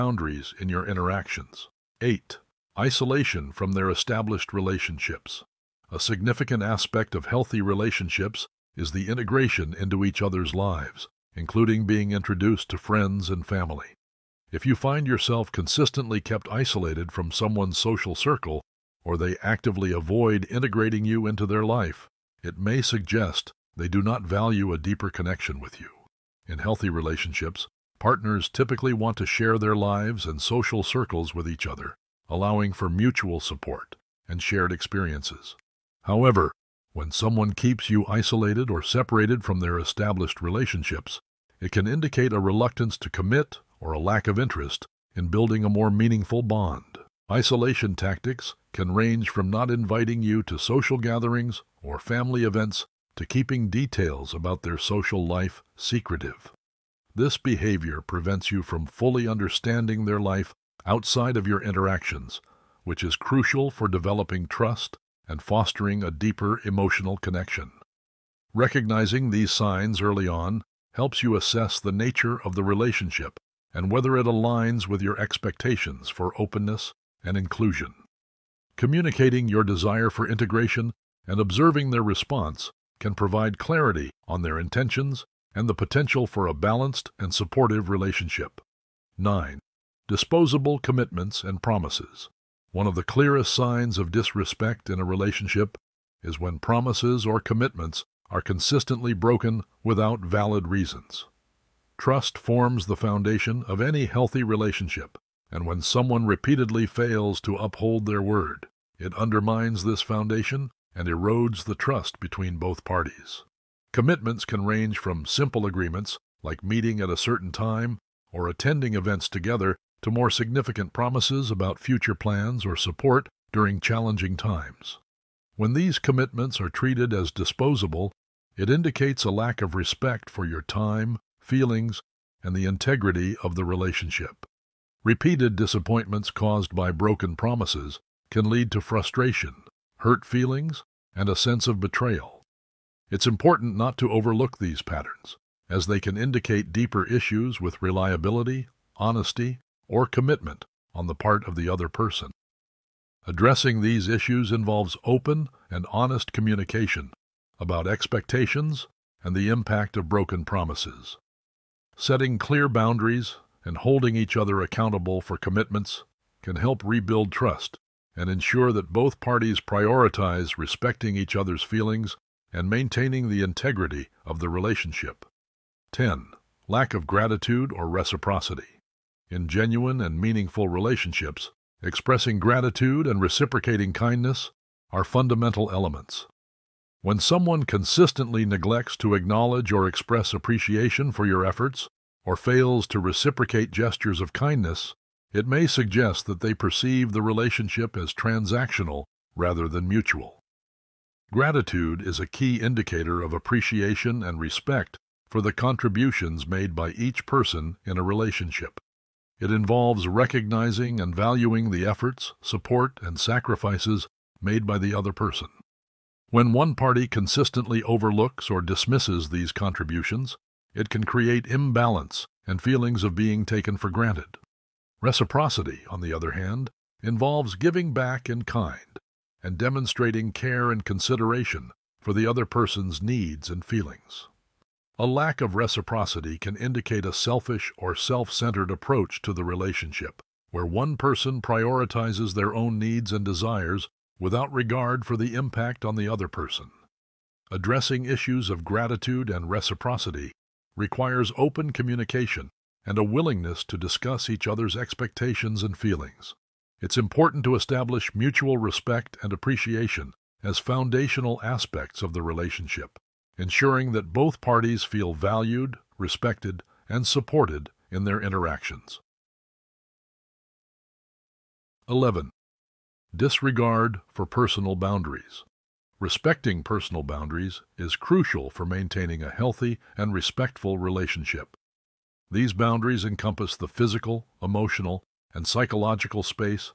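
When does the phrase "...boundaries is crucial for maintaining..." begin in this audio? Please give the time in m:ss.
4:37.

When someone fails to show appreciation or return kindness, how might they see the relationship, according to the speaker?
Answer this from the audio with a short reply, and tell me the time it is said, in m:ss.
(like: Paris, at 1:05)
Transactional, at 3:18.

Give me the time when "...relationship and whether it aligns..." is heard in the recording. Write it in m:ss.
1:12.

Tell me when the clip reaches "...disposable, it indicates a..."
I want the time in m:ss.
2:07.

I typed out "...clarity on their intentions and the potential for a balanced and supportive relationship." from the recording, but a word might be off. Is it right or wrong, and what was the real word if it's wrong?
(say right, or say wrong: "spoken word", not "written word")
right.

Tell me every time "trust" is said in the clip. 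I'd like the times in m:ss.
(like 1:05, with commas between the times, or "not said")
1:04, 1:41, 1:51, 2:47.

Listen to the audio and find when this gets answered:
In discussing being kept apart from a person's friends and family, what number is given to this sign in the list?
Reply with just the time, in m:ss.
0:02.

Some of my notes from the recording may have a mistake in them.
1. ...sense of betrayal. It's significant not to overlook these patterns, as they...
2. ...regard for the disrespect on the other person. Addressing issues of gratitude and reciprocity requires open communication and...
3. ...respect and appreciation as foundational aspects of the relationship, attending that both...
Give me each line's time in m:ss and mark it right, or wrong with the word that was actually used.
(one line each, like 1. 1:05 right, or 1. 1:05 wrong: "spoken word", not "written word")
1. 2:21 wrong: "important", not "significant"
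2. 4:04 wrong: "impact", not "disrespect"
3. 4:18 wrong: "ensuring", not "attending".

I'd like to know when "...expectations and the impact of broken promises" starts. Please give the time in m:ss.
2:37.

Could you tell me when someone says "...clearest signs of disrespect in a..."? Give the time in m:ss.
1:33.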